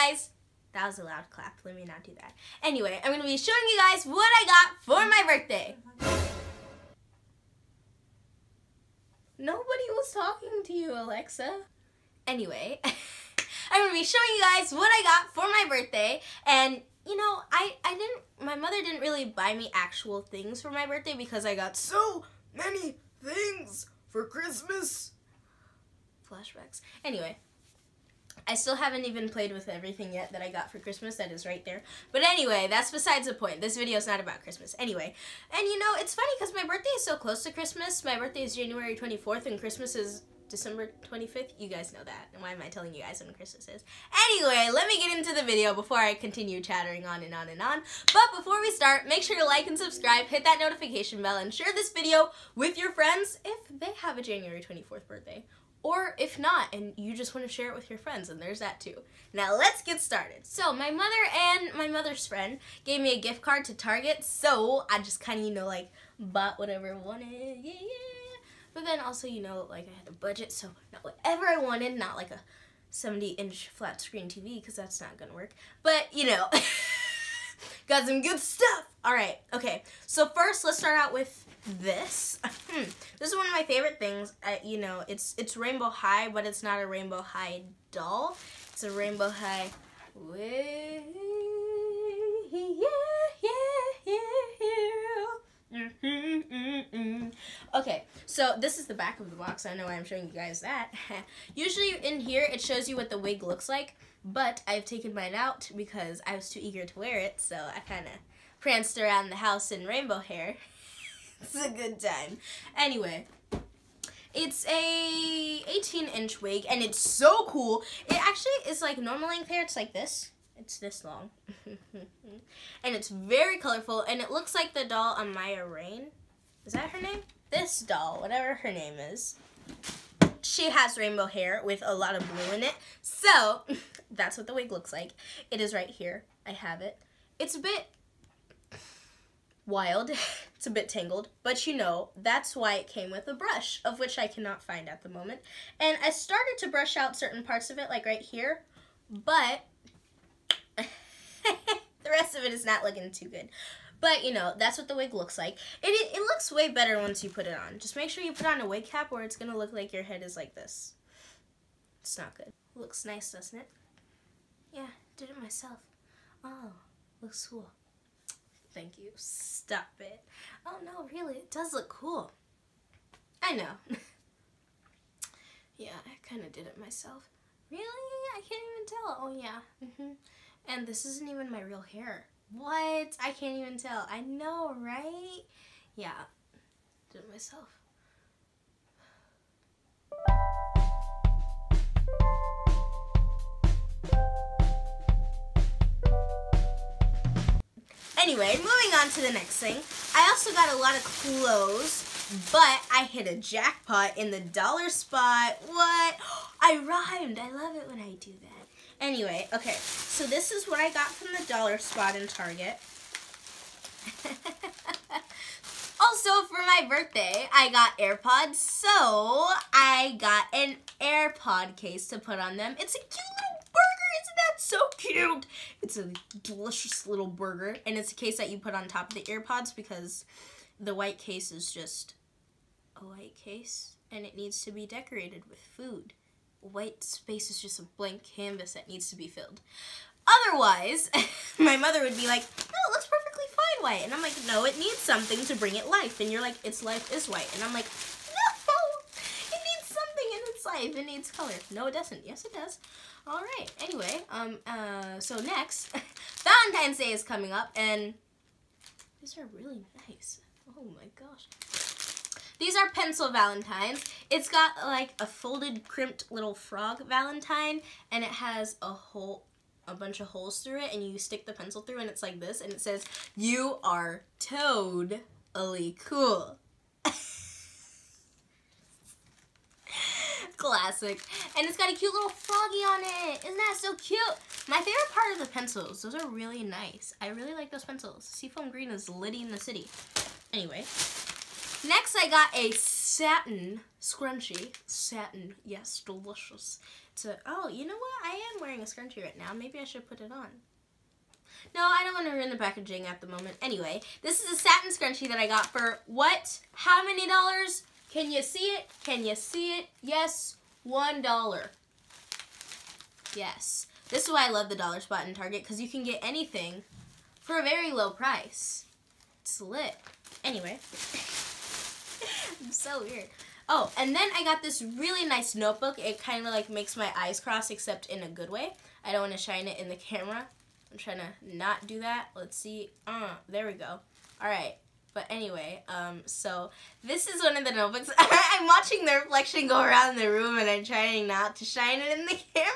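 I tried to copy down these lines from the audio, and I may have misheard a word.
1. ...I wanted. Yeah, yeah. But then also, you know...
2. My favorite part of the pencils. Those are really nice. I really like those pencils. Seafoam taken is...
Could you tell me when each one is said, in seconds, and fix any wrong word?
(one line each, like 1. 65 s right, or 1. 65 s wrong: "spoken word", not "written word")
1. 66 s right
2. 284 s wrong: "green", not "taken".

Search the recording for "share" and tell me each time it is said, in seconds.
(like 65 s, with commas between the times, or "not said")
51 s, 57 s.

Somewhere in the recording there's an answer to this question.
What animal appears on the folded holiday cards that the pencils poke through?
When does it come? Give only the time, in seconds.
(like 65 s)
266 s.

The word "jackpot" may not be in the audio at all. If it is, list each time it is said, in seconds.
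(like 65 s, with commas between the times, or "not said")
203 s.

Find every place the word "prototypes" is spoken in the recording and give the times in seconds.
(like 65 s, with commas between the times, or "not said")
not said.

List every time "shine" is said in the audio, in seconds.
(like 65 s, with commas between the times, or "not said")
329 s, 341 s.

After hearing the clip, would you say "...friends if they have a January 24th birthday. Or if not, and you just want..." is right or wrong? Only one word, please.
right.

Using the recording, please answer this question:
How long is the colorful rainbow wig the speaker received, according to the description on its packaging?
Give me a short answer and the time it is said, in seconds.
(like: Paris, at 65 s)
18 inch, at 115 s.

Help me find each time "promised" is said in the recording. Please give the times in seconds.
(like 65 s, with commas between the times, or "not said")
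not said.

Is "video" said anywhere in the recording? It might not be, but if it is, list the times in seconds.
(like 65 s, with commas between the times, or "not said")
33 s, 45 s, 51 s.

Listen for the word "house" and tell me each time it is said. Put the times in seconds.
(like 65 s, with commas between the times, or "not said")
109 s.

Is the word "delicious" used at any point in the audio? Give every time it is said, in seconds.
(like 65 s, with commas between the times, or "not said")
226 s, 296 s.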